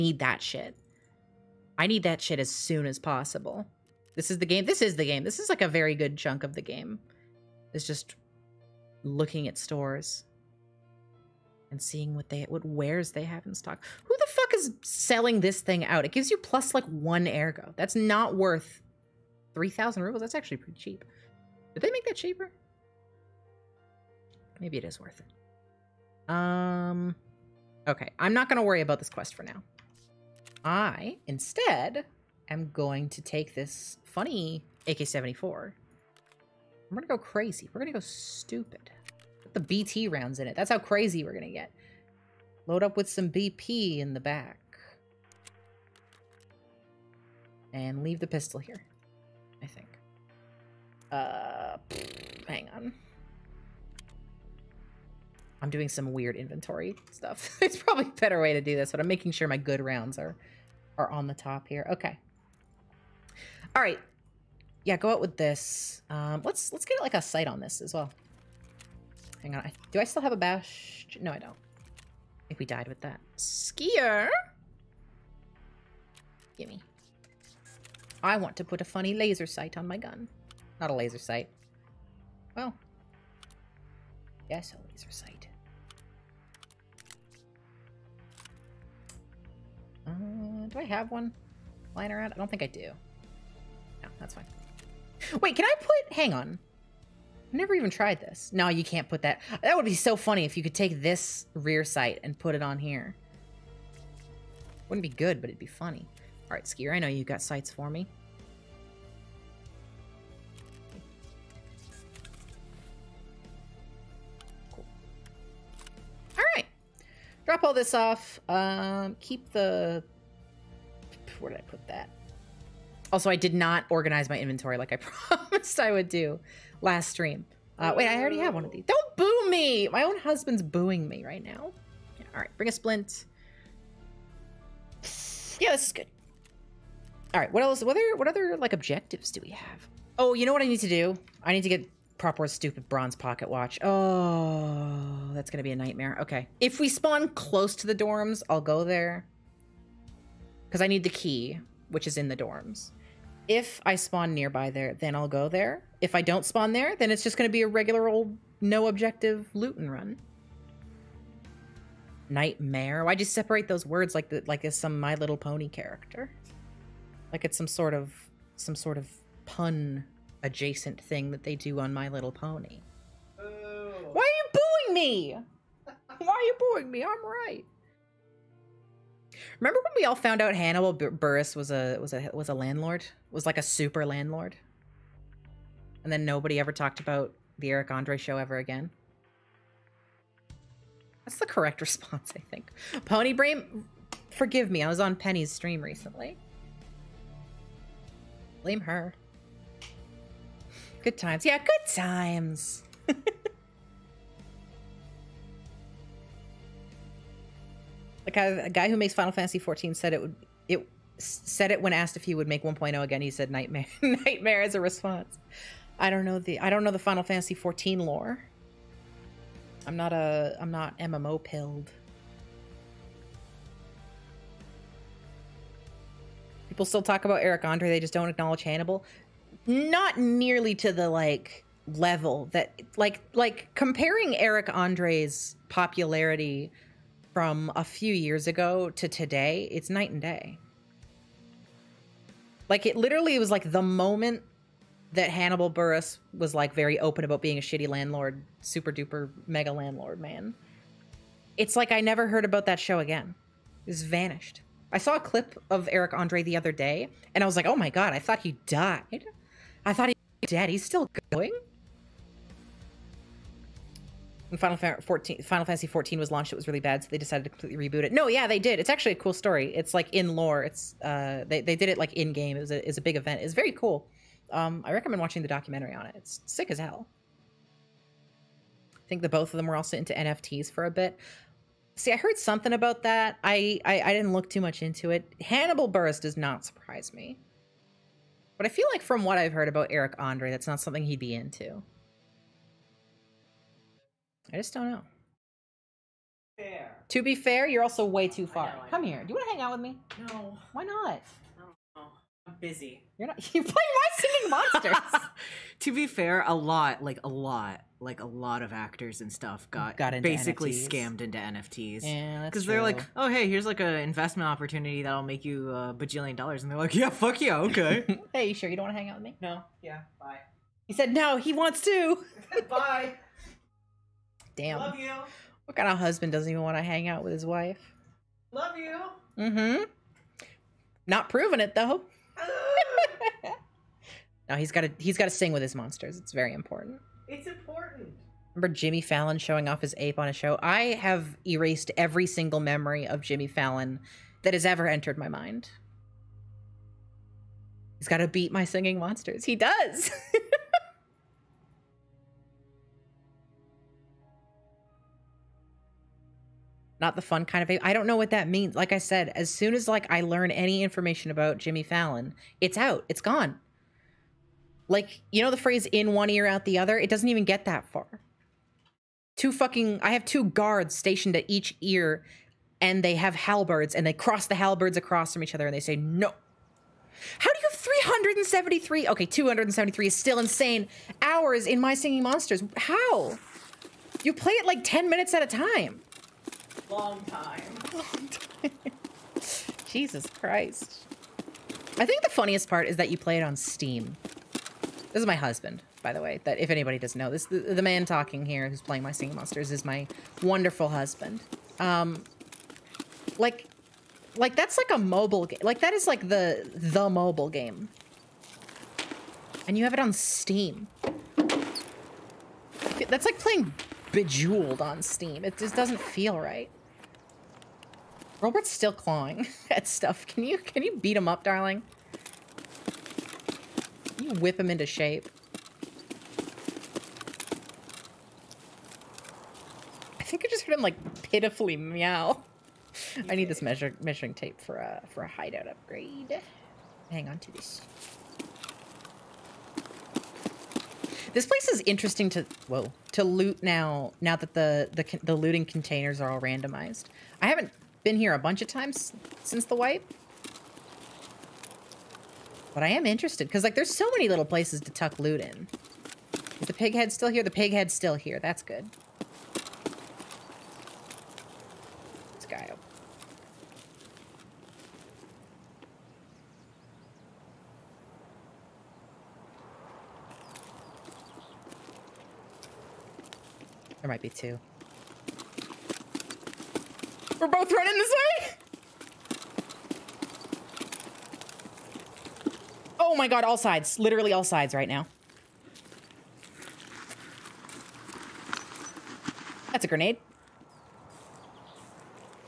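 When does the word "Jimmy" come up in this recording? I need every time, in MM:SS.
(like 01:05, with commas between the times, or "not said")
05:38, 05:43, 06:01.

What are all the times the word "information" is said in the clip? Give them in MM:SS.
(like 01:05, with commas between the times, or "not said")
06:00.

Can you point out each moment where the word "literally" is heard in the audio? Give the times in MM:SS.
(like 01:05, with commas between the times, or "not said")
04:02, 08:03.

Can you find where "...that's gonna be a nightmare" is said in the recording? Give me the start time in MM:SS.
02:25.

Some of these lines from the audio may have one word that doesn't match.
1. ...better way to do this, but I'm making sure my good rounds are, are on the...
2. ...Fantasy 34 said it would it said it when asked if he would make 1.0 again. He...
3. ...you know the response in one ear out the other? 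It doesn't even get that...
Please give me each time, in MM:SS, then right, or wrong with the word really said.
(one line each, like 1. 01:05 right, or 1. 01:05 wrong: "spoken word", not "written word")
1. 00:58 right
2. 03:29 wrong: "14", not "34"
3. 06:05 wrong: "phrase", not "response".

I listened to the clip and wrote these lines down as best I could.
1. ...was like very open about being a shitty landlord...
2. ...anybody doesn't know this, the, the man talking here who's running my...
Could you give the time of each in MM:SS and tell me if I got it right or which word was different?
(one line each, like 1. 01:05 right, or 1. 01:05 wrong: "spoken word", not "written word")
1. 04:06 right
2. 06:36 wrong: "playing", not "running".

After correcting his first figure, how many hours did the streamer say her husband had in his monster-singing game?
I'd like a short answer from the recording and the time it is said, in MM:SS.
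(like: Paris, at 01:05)
273, at 06:19.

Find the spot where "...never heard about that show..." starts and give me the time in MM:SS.
04:12.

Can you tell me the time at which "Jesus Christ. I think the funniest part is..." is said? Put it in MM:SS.
06:29.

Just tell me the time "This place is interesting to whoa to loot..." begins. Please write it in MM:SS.
07:21.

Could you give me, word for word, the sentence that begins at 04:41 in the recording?
See, I heard something about that.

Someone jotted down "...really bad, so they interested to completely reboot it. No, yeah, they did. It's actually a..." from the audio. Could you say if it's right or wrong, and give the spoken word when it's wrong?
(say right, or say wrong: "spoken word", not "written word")
wrong: "decided", not "interested".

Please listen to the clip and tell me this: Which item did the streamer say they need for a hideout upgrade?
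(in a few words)
measuring tape.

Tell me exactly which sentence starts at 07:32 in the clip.
But I am interested, because, like, there's so many little places to tuck loot in.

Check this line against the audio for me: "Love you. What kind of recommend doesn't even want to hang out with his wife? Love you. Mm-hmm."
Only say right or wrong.
wrong.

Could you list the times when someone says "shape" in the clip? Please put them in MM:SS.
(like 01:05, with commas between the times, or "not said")
07:04.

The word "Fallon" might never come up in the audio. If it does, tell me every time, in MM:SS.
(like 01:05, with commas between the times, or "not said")
05:39, 05:43, 06:01.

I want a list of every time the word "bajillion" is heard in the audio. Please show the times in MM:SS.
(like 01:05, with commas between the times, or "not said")
05:15.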